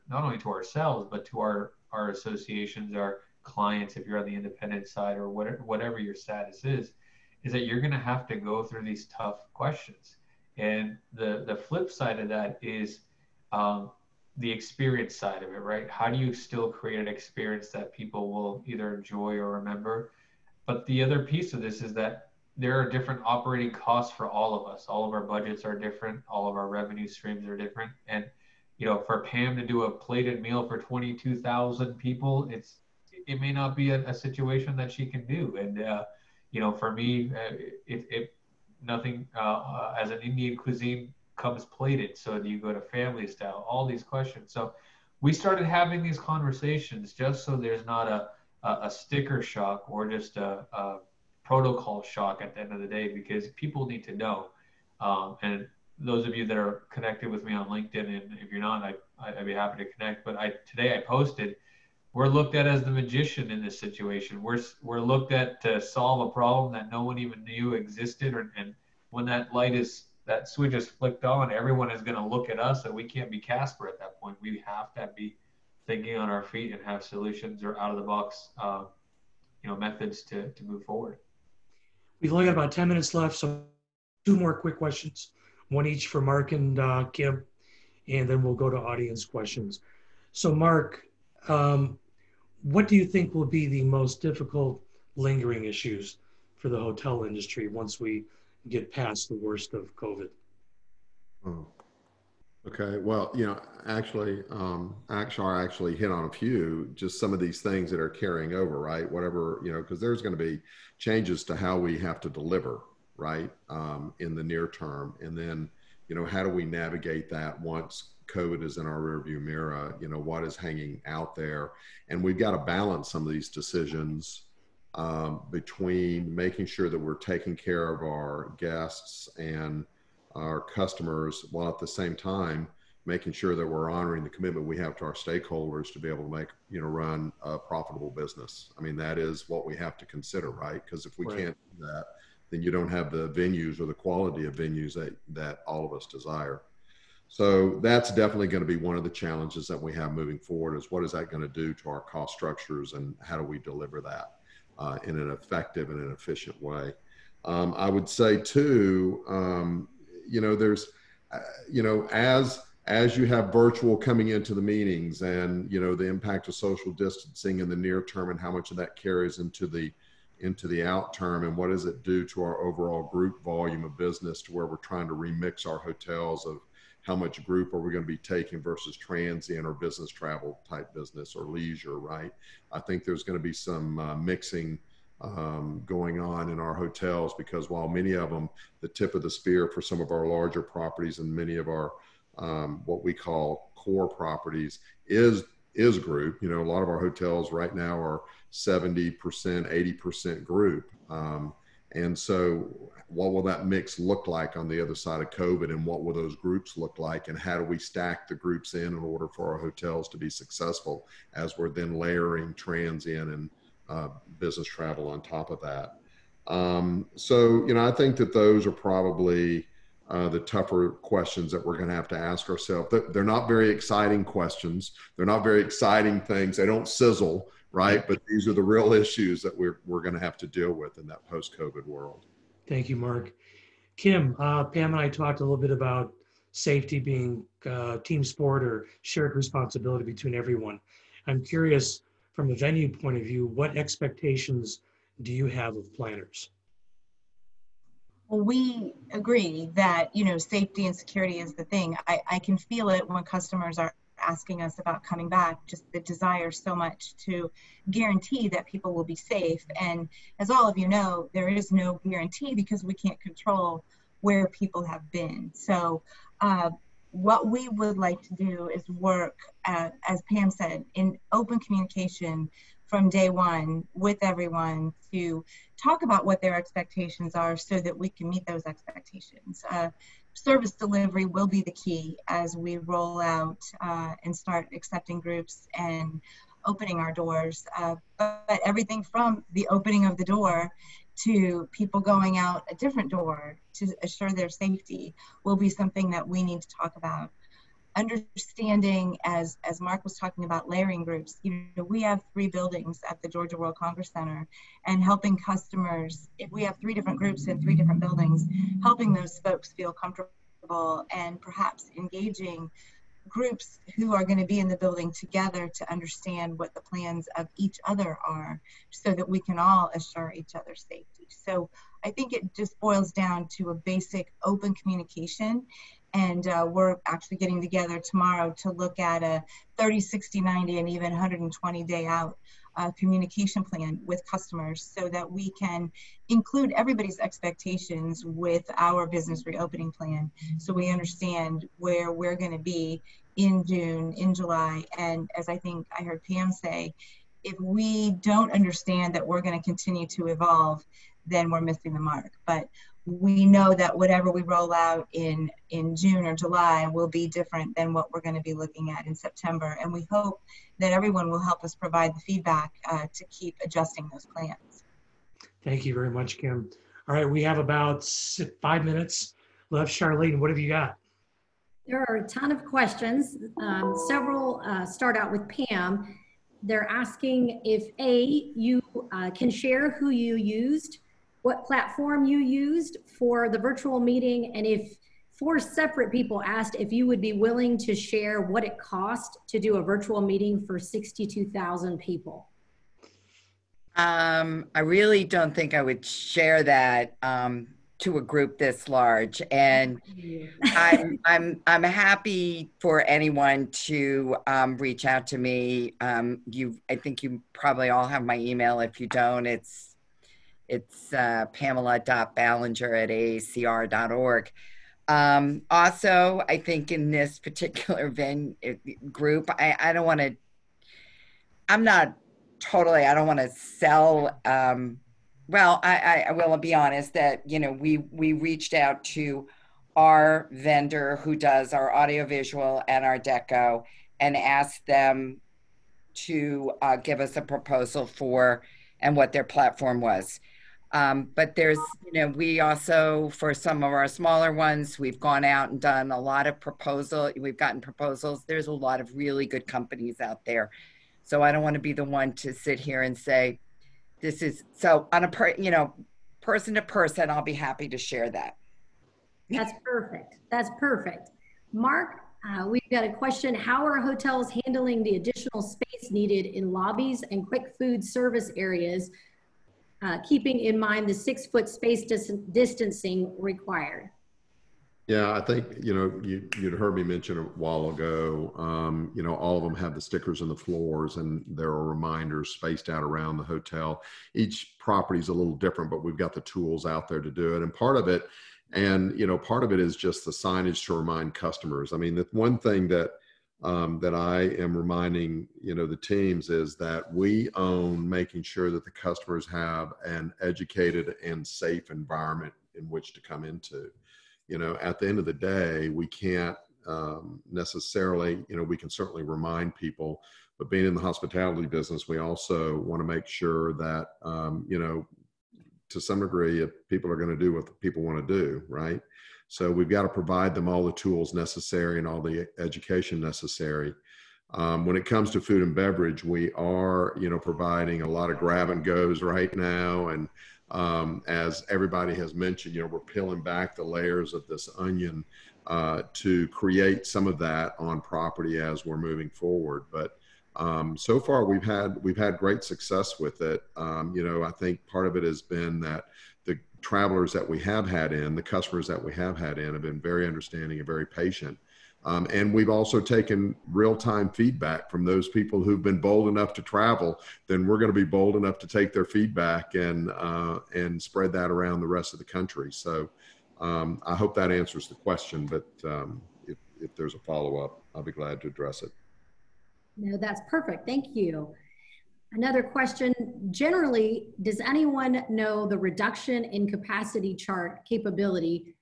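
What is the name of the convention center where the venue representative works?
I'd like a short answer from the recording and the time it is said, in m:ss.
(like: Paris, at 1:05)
Georgia World Congress Center, at 5:03.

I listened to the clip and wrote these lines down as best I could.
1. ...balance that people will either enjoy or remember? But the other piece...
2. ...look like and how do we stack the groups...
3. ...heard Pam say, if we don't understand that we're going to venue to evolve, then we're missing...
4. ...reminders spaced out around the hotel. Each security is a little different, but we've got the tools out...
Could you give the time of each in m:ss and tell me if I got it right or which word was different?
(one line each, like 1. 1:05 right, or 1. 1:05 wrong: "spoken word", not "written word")
1. 0:17 wrong: "experience", not "balance"
2. 3:26 right
3. 5:46 wrong: "continue", not "venue"
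4. 8:01 wrong: "property", not "security".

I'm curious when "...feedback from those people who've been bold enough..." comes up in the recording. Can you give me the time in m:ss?
9:14.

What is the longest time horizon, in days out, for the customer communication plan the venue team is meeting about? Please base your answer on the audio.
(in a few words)
120.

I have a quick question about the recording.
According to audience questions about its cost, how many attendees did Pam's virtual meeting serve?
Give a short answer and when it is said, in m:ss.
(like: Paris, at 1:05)
62,000, at 6:30.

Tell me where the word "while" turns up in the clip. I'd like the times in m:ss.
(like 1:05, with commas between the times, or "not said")
2:11, 3:07, 7:57.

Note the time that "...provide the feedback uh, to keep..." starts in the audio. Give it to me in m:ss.
6:01.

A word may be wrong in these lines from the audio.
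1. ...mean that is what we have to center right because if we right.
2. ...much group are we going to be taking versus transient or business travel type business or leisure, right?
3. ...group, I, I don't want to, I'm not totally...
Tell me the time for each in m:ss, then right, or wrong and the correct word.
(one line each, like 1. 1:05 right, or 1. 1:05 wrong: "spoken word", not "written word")
1. 2:18 wrong: "consider", not "center"
2. 2:57 right
3. 6:59 right.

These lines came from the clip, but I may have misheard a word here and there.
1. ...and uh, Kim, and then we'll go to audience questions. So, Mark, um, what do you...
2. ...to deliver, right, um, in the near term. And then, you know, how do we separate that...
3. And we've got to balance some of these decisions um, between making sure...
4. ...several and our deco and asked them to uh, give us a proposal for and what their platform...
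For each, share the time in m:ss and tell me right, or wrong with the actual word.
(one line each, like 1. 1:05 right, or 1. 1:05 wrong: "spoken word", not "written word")
1. 1:26 right
2. 1:52 wrong: "navigate", not "separate"
3. 2:02 right
4. 7:11 wrong: "audiovisual", not "several".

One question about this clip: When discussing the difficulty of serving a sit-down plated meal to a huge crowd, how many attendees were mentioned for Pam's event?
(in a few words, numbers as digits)
22,000.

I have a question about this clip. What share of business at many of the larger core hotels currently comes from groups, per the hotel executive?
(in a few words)
70%, 80%.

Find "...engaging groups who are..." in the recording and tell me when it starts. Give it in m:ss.
5:11.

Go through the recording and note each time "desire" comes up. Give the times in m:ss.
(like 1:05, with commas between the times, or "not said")
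2:26, 4:15.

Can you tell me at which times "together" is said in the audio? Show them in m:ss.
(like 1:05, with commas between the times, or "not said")
5:15, 5:27.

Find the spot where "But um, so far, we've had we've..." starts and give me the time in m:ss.
8:59.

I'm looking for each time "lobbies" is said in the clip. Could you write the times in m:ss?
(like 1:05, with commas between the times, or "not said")
7:46.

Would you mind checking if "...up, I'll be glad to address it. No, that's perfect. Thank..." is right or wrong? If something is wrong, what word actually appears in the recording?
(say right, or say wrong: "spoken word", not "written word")
right.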